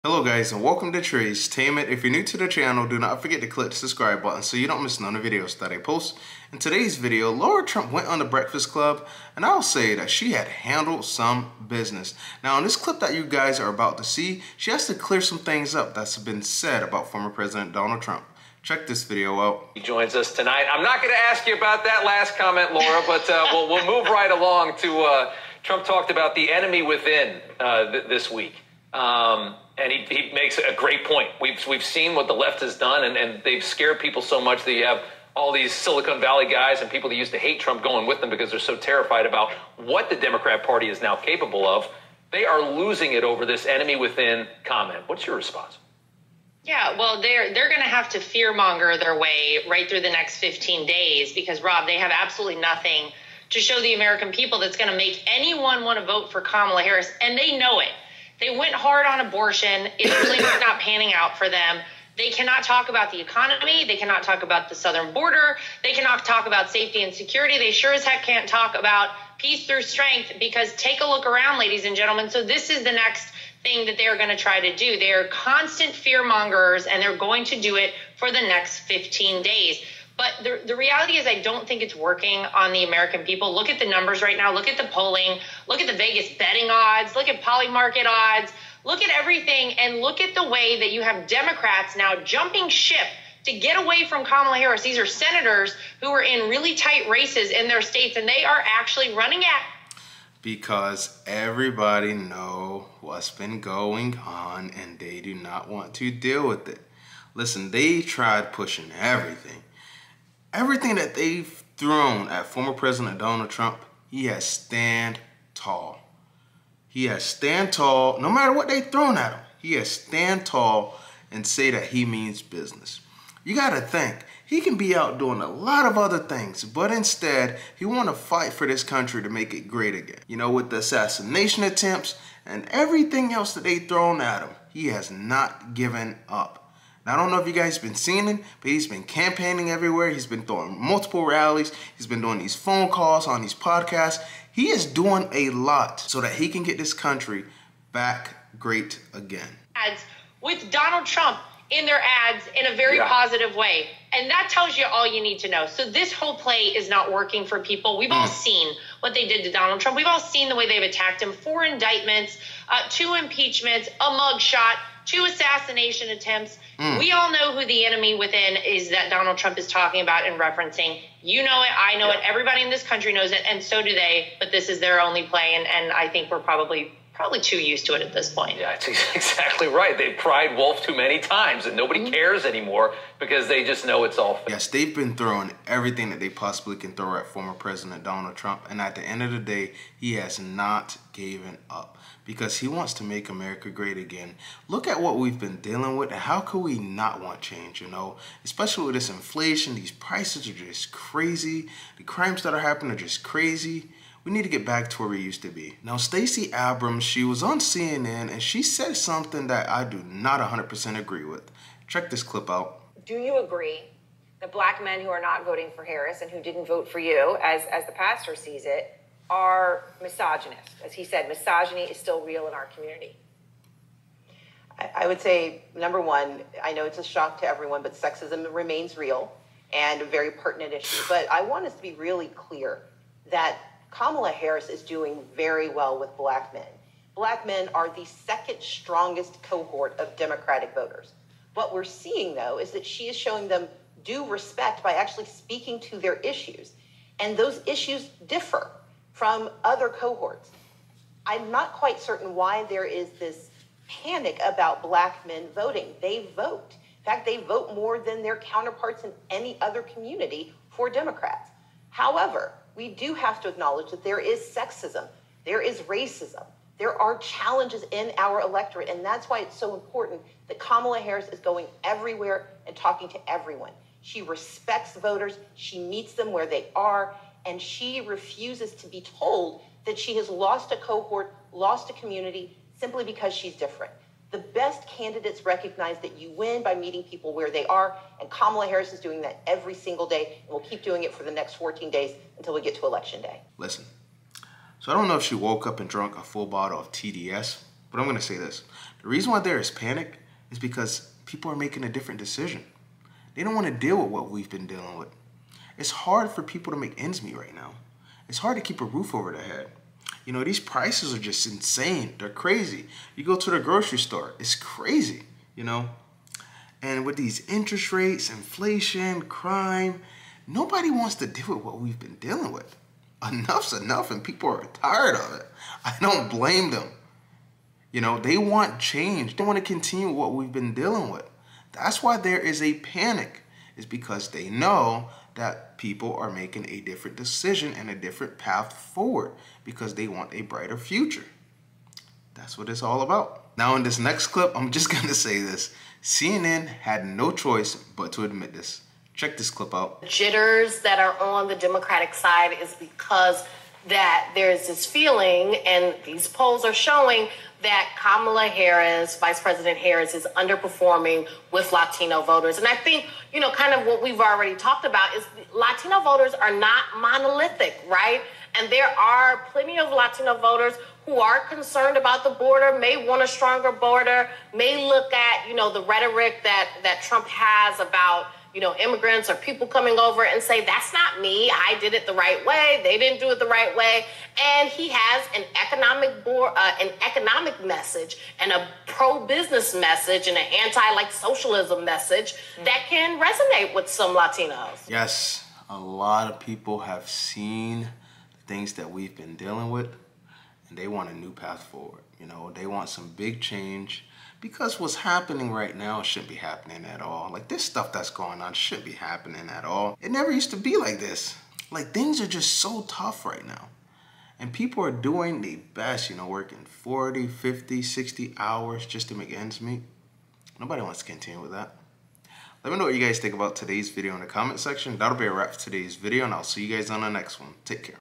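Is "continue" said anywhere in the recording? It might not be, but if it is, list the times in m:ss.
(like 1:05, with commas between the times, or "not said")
5:29, 7:01.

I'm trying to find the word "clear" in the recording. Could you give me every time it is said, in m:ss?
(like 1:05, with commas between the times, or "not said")
0:14, 3:52.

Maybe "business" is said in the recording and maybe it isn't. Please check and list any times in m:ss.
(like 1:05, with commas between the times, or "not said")
0:11, 2:02, 6:29.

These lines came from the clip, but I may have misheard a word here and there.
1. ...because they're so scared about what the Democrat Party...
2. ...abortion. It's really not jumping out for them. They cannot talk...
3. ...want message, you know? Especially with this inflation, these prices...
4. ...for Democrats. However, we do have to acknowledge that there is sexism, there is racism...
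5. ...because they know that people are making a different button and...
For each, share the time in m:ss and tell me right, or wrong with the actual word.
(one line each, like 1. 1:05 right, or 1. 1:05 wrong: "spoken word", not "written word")
1. 0:38 wrong: "terrified", not "scared"
2. 0:59 wrong: "panning", not "jumping"
3. 3:17 wrong: "change", not "message"
4. 4:20 right
5. 5:33 wrong: "decision", not "button".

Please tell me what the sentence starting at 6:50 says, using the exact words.
It never used to be like this.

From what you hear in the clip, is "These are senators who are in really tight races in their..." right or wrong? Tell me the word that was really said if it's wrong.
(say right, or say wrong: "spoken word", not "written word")
right.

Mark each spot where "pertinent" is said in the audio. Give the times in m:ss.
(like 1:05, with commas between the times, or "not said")
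3:50.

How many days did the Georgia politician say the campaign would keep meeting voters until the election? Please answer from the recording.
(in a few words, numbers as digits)
14.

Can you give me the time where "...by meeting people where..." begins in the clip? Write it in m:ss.
4:46.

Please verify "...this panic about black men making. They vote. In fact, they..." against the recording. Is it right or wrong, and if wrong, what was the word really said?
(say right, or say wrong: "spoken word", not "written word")
wrong: "voting", not "making".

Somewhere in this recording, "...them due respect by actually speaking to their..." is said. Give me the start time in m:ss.
4:03.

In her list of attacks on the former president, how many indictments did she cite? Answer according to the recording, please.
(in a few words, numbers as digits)
4.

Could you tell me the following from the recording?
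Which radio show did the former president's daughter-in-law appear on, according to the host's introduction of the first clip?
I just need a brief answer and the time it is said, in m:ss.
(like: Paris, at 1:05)
The Breakfast Club, at 0:08.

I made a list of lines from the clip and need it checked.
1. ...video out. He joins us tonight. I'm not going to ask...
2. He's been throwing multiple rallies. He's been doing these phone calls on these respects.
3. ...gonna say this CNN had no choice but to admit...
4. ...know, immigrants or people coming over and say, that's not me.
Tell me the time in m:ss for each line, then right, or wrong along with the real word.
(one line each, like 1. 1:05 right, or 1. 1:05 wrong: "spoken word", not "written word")
1. 0:19 right
2. 2:20 wrong: "podcasts", not "respects"
3. 5:44 right
4. 6:18 right.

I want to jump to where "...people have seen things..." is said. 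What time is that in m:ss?
6:36.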